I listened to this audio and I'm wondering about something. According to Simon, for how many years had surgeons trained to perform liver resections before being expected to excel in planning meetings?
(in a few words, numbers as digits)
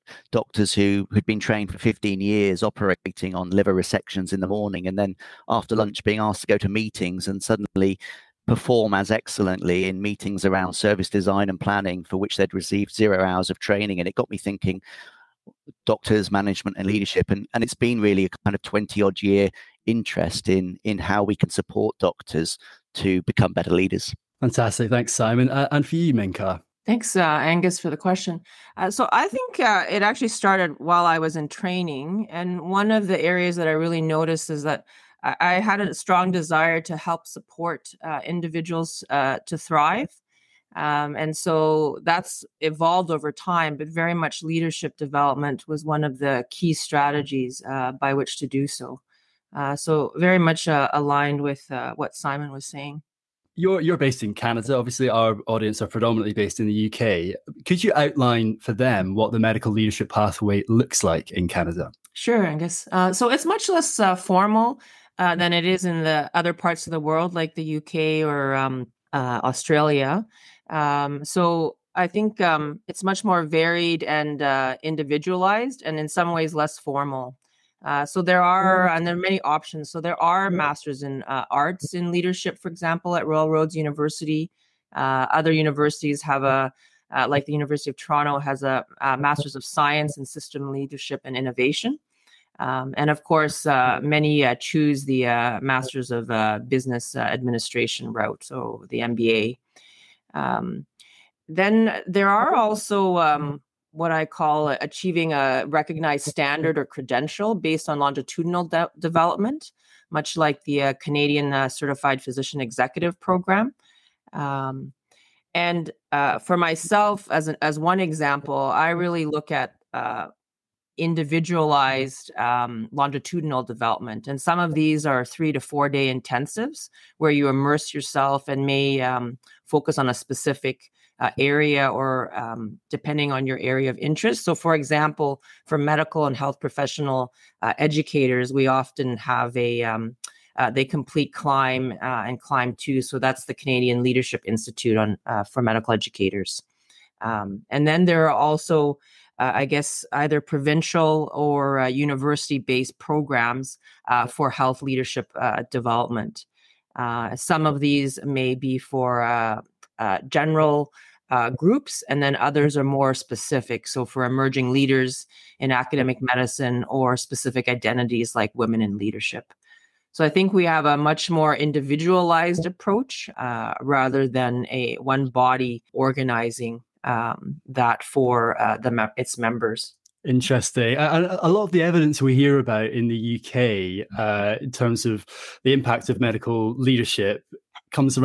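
15.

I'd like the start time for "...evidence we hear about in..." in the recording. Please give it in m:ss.
3:01.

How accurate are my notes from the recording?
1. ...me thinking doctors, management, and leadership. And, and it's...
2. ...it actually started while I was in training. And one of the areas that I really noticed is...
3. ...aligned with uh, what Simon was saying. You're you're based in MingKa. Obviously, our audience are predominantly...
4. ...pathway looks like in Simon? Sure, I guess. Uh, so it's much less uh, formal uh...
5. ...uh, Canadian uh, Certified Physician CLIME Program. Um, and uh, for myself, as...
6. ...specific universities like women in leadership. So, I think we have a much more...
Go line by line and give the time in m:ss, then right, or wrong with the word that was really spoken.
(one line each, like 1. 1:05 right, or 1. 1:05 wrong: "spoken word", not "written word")
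1. 0:14 right
2. 0:29 right
3. 0:50 wrong: "Canada", not "MingKa"
4. 1:00 wrong: "Canada", not "Simon"
5. 1:50 wrong: "Executive", not "CLIME"
6. 2:47 wrong: "identities", not "universities".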